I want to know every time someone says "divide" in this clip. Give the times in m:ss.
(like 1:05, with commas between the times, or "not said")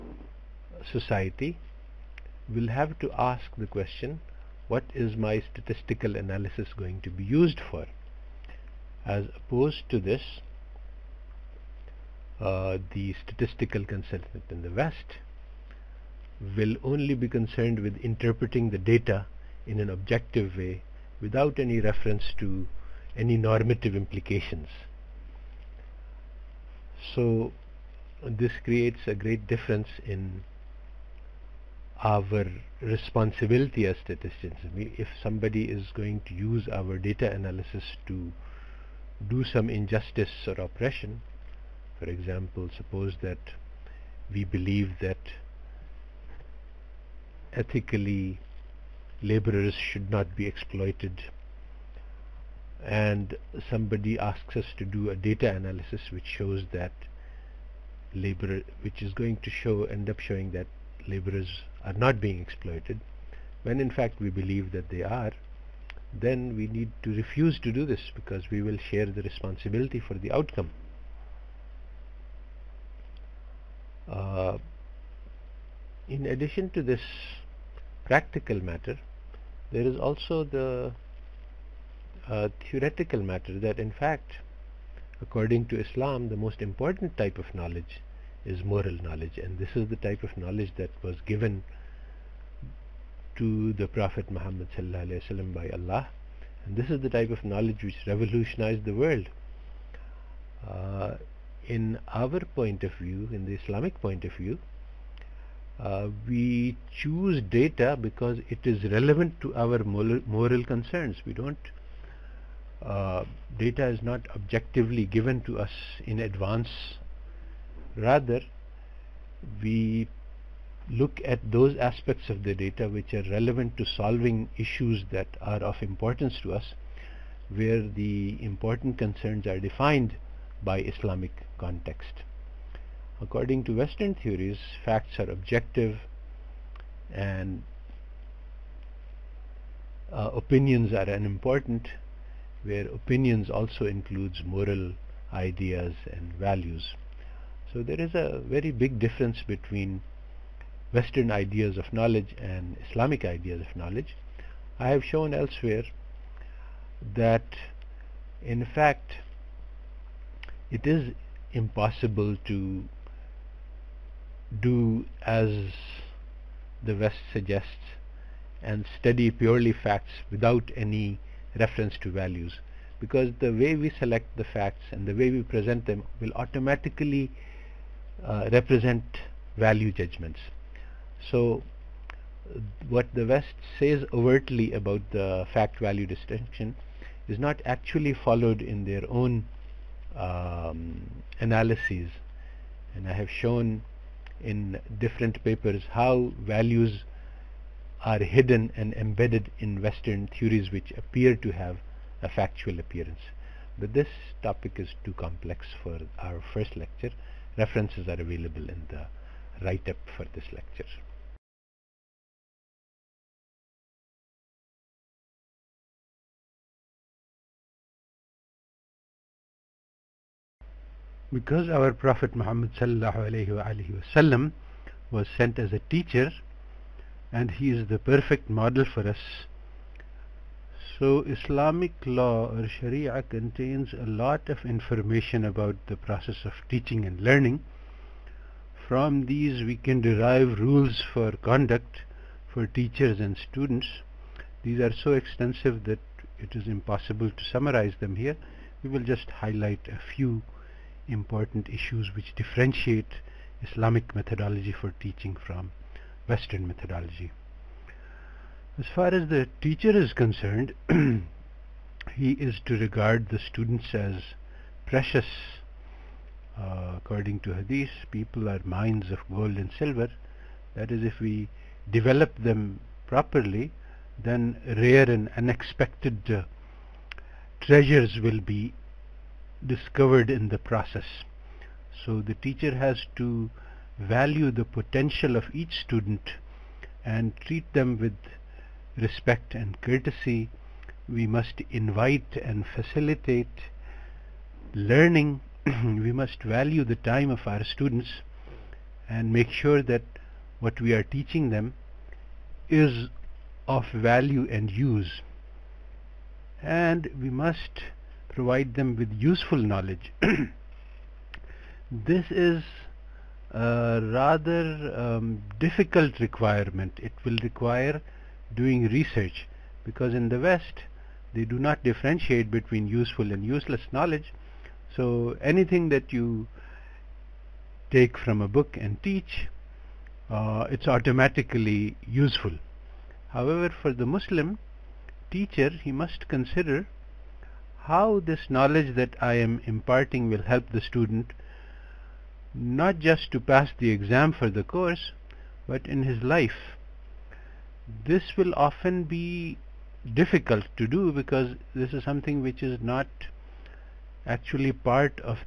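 not said.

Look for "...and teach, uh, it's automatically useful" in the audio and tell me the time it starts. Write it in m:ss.
5:28.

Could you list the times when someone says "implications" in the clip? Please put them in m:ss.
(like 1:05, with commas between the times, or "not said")
0:23.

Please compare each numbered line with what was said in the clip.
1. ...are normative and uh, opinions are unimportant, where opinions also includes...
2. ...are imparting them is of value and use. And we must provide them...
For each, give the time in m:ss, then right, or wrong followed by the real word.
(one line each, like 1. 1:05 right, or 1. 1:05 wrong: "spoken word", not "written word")
1. 2:15 wrong: "objective", not "normative"
2. 5:00 wrong: "teaching", not "imparting".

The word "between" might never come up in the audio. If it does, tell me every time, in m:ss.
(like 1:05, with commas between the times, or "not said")
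2:29, 5:22.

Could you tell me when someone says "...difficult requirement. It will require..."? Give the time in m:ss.
5:15.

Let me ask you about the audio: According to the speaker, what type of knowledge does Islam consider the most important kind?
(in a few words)
Moral knowledge.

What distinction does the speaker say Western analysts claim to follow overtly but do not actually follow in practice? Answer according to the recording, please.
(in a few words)
Fact-value distinction.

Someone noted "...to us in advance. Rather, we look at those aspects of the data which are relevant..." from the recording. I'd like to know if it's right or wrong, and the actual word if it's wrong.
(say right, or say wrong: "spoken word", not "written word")
right.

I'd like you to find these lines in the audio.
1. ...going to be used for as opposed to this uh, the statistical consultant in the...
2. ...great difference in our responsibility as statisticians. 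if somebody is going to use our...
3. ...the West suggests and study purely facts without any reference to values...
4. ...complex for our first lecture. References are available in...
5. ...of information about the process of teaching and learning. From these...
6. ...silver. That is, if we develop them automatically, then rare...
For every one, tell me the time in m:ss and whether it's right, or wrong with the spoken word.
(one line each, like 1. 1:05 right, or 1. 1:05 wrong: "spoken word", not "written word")
1. 0:06 right
2. 0:29 right
3. 2:46 right
4. 3:25 right
5. 3:54 right
6. 4:29 wrong: "properly", not "automatically".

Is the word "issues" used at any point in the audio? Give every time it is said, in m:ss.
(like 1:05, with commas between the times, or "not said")
2:04, 4:11.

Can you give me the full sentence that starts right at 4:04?
These are so extensive that it is impossible to summarize them here.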